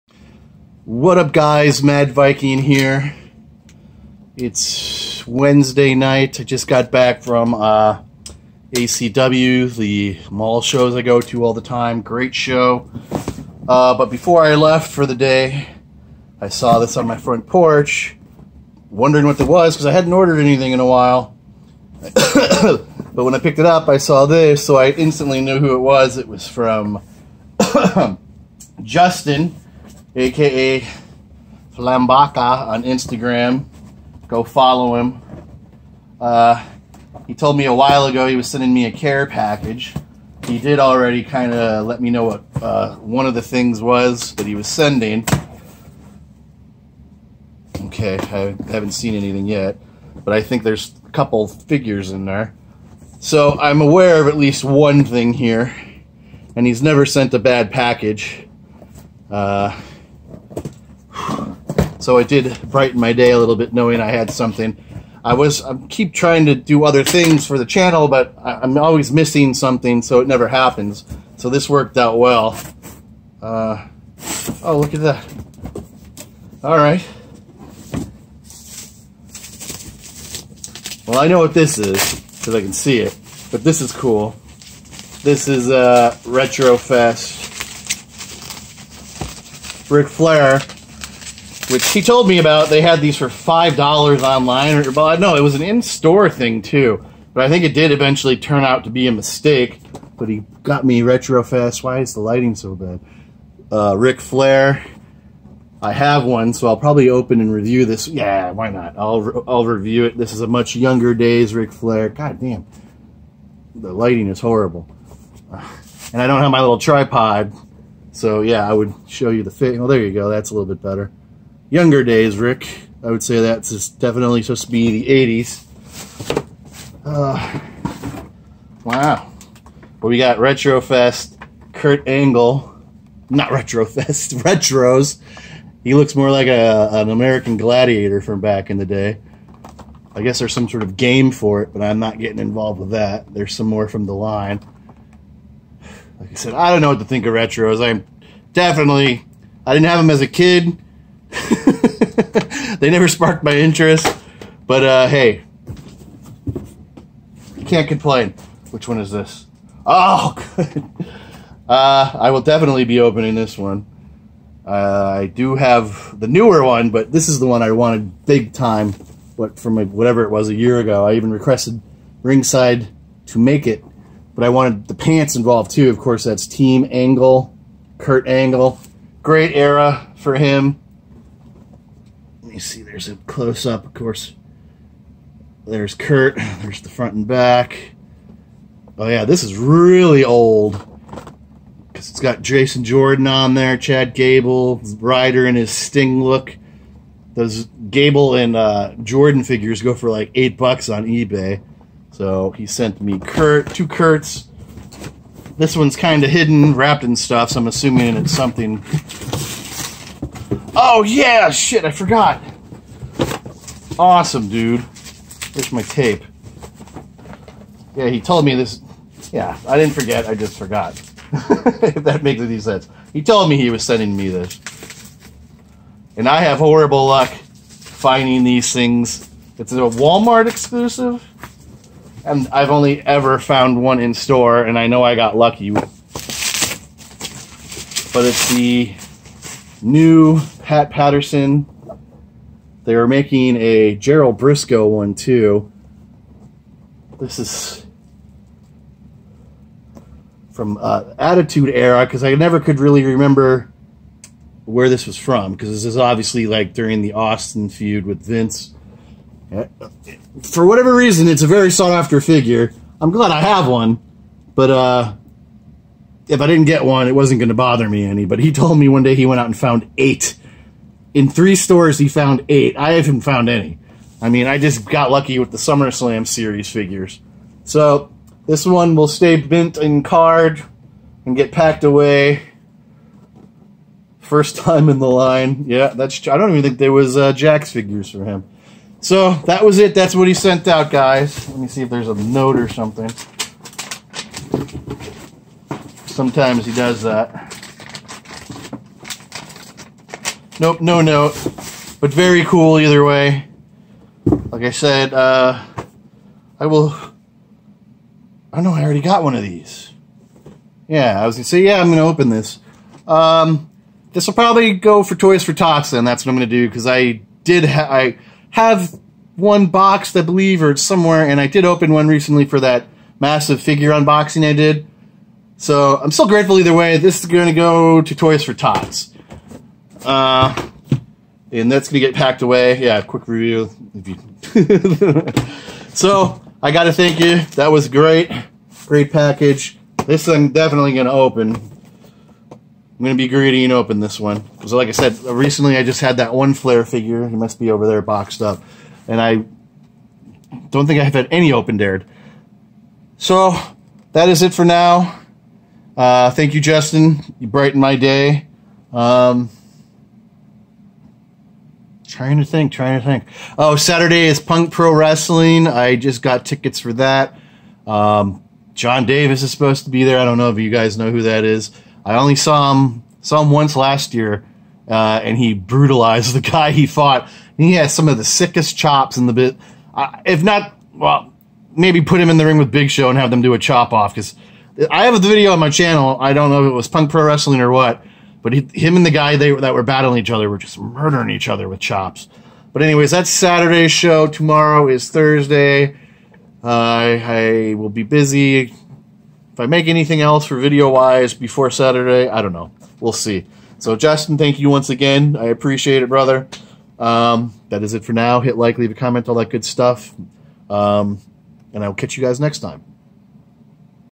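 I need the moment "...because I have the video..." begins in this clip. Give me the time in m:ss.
6:24.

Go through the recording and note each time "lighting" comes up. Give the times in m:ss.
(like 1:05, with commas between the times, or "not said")
1:42, 1:53.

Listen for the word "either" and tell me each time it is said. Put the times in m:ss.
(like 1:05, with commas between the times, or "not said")
5:02, 5:26.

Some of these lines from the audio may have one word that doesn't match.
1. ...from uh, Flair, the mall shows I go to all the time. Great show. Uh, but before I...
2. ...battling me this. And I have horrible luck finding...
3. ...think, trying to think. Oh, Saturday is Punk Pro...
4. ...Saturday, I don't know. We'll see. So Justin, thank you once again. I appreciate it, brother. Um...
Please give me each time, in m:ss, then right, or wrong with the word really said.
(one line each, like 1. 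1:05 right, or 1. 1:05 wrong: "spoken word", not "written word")
1. 0:07 wrong: "ACW", not "Flair"
2. 3:43 wrong: "sending", not "battling"
3. 6:02 right
4. 6:41 right.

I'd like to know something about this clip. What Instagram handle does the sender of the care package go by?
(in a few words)
Flambaca.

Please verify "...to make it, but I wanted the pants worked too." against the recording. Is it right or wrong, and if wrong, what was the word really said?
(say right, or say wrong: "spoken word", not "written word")
wrong: "involved", not "worked".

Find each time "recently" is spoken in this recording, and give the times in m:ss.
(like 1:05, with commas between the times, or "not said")
5:22, 5:45.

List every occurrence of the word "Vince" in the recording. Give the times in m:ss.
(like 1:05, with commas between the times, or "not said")
4:18.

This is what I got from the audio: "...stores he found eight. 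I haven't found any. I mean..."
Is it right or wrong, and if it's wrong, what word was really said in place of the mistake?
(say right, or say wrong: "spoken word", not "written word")
right.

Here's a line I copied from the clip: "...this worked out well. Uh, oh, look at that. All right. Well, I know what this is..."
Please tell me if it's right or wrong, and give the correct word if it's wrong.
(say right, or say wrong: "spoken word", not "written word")
right.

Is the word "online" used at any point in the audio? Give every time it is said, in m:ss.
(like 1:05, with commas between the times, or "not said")
1:34.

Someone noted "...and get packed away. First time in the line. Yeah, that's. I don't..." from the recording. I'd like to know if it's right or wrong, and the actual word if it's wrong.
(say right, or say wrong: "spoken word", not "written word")
right.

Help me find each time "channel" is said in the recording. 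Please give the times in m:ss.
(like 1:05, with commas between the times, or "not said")
1:07, 6:25.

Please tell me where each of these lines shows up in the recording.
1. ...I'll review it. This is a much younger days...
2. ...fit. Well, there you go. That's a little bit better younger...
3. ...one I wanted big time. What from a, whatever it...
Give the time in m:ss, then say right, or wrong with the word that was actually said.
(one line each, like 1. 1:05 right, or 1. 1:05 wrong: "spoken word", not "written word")
1. 1:49 right
2. 1:59 right
3. 2:47 right.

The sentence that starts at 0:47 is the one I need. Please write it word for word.
Okay, I haven't seen anything yet, but I think there's a couple figures in there.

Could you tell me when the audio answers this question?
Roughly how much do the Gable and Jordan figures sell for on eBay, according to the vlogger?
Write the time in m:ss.
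3:20.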